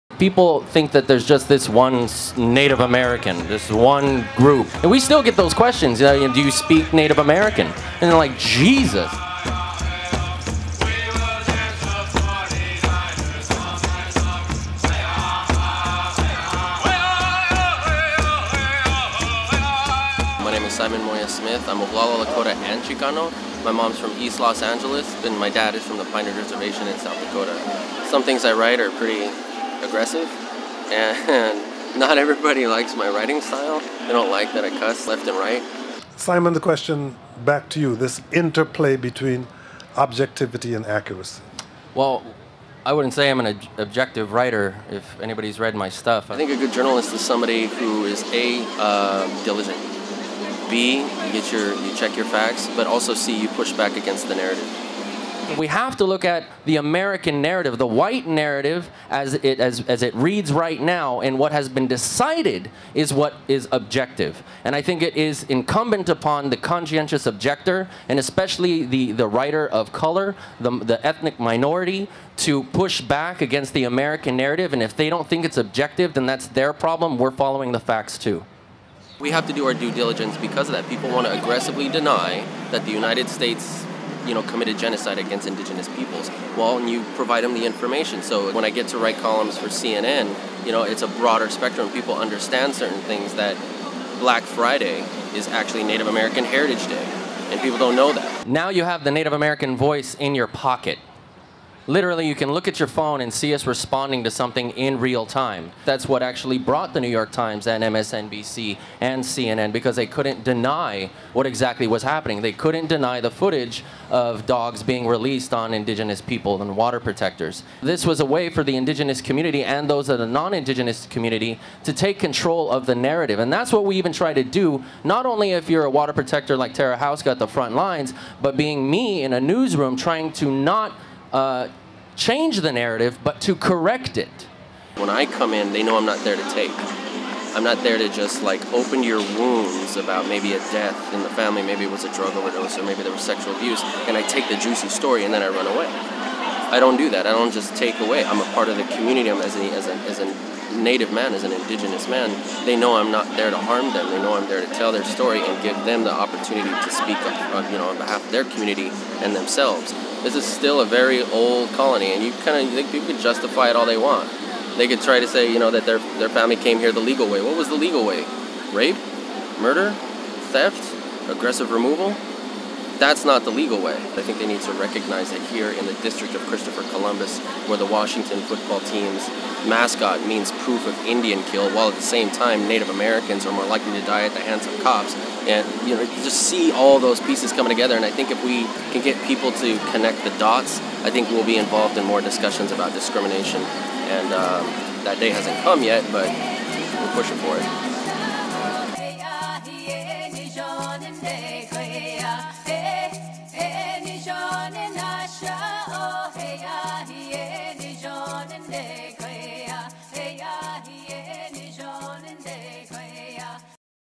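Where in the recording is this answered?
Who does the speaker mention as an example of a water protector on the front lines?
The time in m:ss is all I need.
2:06.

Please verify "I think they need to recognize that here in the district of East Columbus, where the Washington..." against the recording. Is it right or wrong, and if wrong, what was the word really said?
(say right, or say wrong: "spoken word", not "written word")
wrong: "Christopher", not "East".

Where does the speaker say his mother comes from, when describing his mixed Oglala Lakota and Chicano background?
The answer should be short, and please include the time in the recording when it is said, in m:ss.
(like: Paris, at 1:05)
East Los Angeles, at 0:24.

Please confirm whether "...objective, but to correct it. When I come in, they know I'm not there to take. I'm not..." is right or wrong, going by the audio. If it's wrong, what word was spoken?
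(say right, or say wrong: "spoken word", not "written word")
wrong: "narrative", not "objective".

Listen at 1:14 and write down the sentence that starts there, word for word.
And if they don't think it's objective, then that's their problem.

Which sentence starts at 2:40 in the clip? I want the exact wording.
This is still a very old colony, and you kind of think people can justify it all they want.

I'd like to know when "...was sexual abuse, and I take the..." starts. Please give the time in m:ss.
2:23.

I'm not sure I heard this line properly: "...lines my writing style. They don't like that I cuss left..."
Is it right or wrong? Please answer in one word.
wrong.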